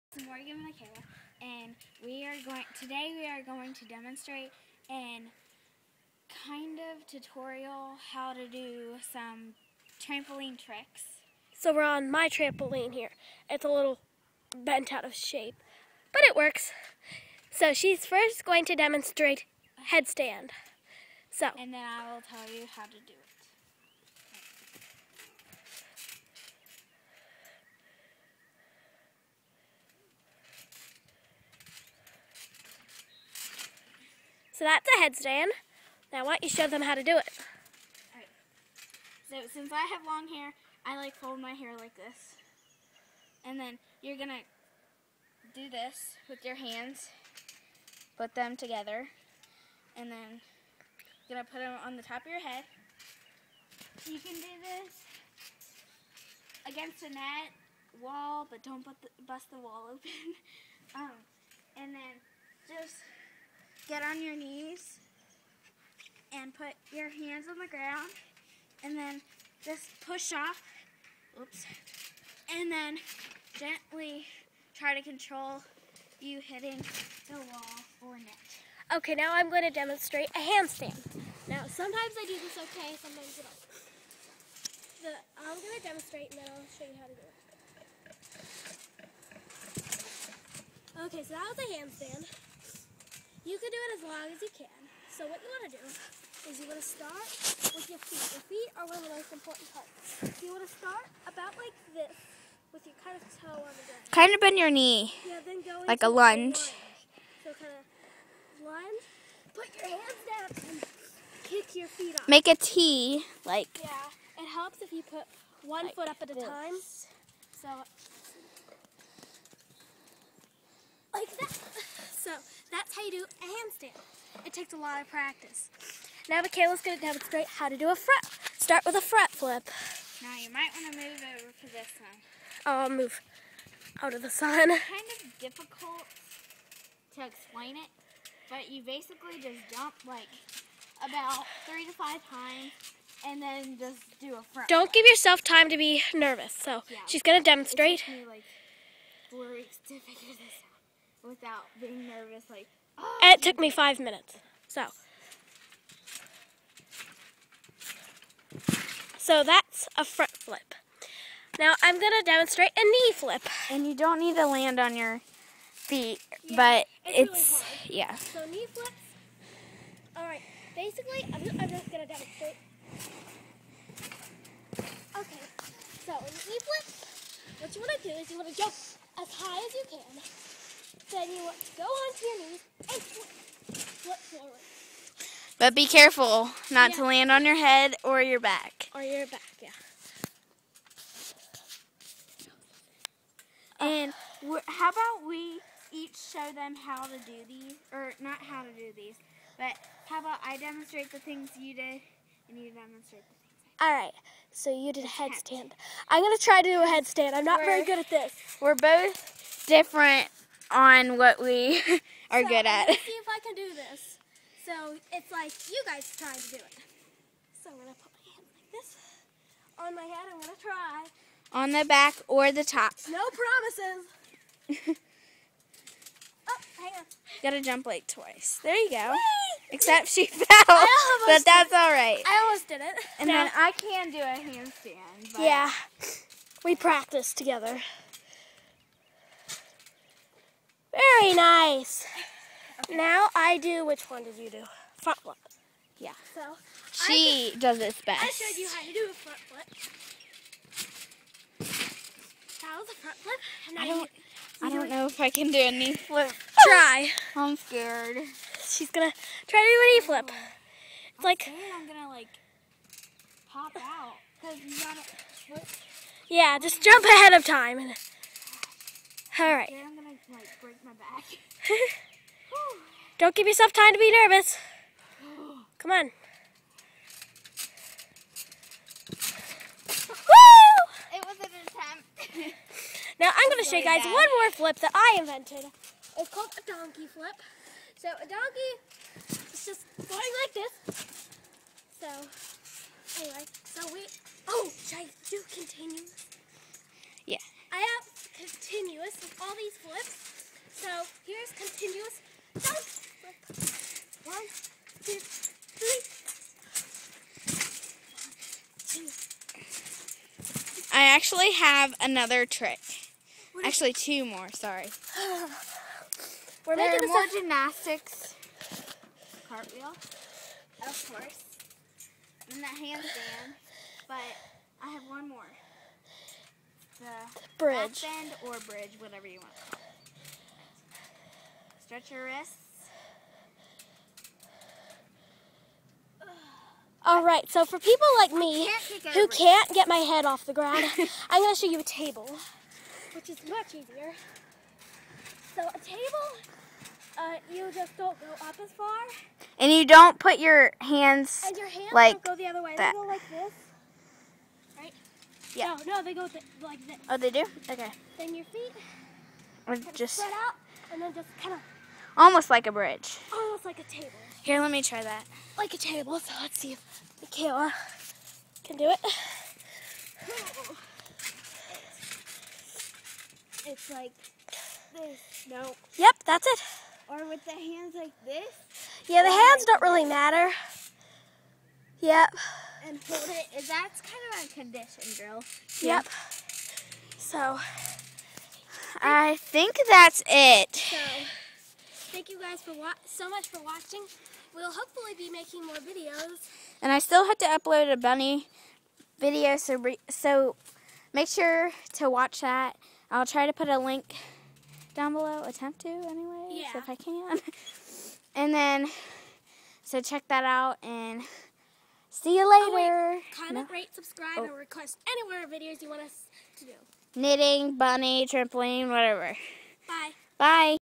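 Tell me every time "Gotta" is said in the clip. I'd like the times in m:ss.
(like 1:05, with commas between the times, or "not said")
3:47.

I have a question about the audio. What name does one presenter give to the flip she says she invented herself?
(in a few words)
Donkey flip.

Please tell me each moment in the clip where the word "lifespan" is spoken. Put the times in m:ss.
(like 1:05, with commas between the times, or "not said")
not said.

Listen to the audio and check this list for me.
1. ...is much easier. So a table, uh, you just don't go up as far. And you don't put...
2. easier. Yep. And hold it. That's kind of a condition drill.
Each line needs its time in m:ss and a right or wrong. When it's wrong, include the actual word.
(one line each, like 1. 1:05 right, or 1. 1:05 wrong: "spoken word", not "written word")
1. 5:43 right
2. 6:20 wrong: "matter", not "easier".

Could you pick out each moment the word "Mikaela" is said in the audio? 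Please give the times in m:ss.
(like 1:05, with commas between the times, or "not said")
0:00, 2:06, 6:07.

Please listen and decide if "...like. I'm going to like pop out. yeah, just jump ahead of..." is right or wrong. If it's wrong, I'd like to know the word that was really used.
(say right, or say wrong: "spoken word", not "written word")
right.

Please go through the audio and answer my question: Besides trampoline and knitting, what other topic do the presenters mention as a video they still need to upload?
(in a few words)
Bunny video.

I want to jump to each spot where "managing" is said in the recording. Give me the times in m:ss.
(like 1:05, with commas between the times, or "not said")
not said.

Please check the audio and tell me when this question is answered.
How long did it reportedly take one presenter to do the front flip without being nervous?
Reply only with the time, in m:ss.
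2:33.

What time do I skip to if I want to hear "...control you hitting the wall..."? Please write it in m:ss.
1:15.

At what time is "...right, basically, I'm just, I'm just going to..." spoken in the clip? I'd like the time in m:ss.
2:50.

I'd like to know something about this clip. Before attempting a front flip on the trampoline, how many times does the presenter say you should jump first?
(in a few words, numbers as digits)
3 to 5.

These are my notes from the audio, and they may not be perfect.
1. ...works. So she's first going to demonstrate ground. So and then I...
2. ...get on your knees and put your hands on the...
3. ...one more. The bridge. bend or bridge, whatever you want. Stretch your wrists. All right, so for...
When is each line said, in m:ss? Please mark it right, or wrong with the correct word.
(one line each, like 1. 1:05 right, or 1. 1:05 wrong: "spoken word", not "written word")
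1. 0:16 wrong: "headstand", not "ground"
2. 1:03 right
3. 5:25 right.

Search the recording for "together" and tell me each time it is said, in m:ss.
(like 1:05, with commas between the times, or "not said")
0:48, 3:57.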